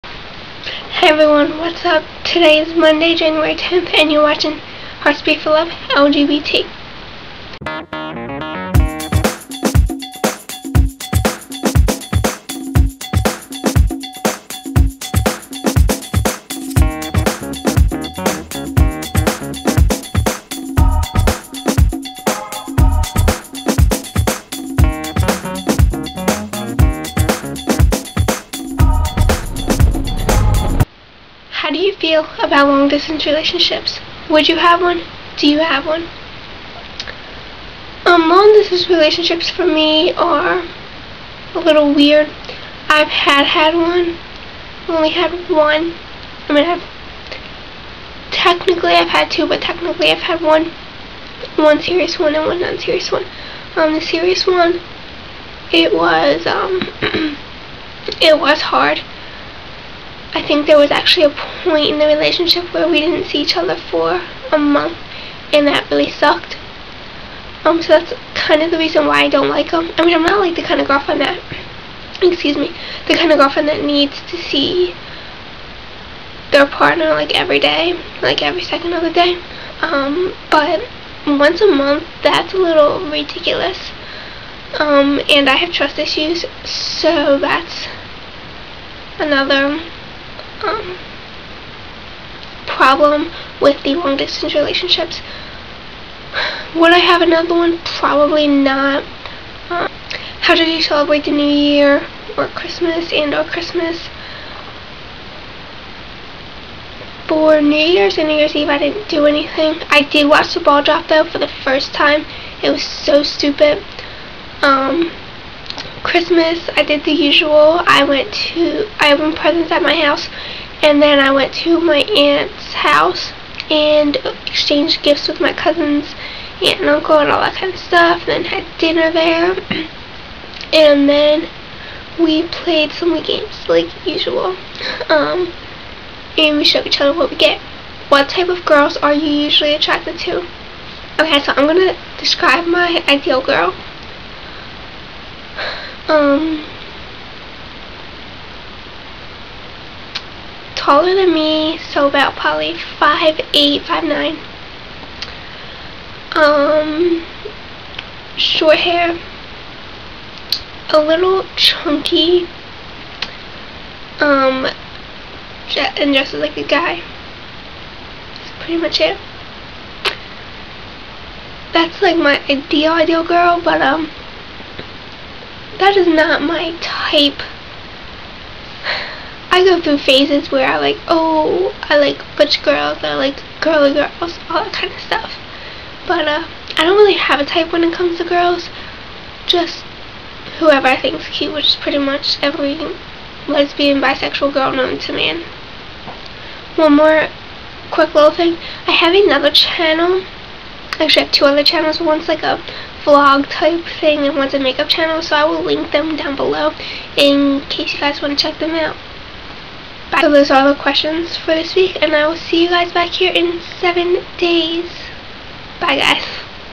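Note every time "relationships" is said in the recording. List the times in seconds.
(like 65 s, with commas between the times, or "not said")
33 s, 38 s, 62 s, 94 s.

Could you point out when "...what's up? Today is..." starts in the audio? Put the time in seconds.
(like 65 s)
1 s.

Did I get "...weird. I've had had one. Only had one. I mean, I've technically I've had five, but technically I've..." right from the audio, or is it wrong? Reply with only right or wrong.
wrong.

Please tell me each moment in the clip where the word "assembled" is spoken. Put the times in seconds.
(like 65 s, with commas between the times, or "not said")
not said.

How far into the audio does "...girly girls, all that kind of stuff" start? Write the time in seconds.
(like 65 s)
183 s.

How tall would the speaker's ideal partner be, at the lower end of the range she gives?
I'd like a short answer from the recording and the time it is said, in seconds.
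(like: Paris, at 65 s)
5'8", at 152 s.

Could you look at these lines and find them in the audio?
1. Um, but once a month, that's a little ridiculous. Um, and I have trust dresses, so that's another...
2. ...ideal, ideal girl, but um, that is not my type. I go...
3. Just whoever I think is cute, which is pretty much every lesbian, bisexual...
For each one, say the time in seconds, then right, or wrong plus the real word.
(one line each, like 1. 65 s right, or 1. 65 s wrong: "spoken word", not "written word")
1. 79 s wrong: "issues", not "dresses"
2. 172 s right
3. 189 s right.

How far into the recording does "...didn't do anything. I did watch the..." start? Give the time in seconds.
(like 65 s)
108 s.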